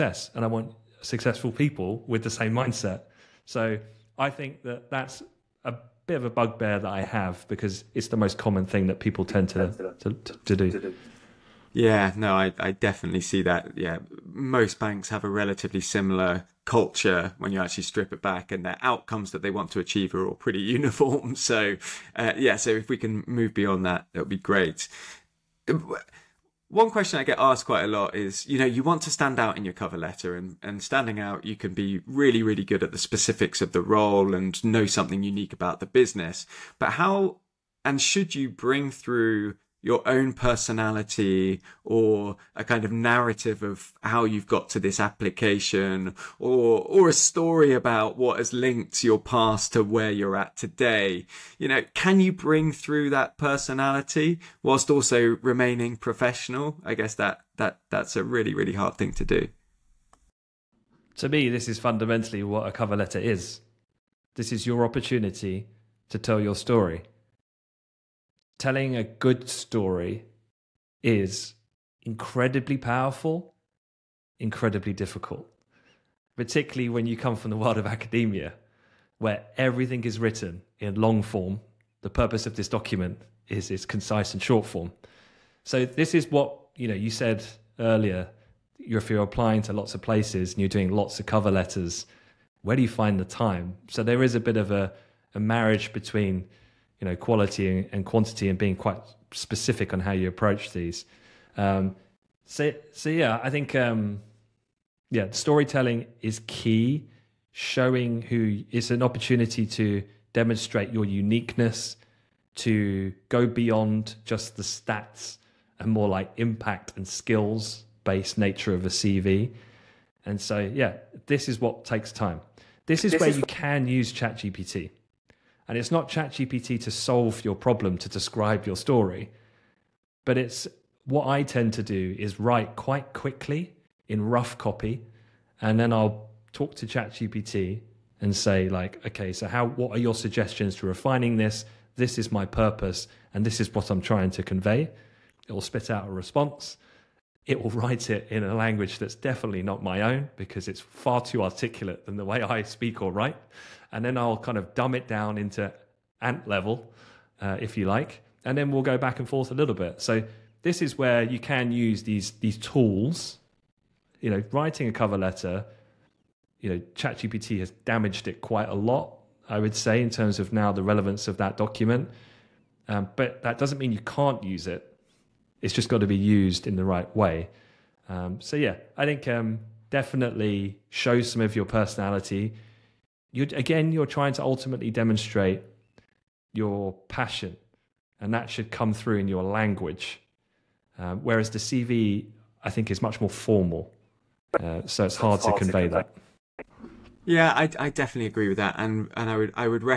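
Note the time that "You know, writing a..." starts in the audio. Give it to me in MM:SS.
02:44.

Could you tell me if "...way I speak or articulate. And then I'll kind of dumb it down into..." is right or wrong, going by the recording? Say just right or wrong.
wrong.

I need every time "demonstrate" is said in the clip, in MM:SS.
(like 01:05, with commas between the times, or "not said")
01:50, 03:04.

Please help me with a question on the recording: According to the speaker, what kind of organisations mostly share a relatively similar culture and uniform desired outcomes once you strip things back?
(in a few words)
Banks.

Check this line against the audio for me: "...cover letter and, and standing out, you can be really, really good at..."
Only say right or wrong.
right.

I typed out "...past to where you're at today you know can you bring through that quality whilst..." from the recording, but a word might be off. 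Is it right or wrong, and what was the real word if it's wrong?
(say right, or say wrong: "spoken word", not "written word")
wrong: "personality", not "quality".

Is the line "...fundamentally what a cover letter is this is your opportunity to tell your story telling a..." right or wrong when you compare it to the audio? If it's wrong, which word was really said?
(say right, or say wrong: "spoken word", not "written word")
right.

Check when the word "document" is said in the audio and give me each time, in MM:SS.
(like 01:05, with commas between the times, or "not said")
01:22, 02:51.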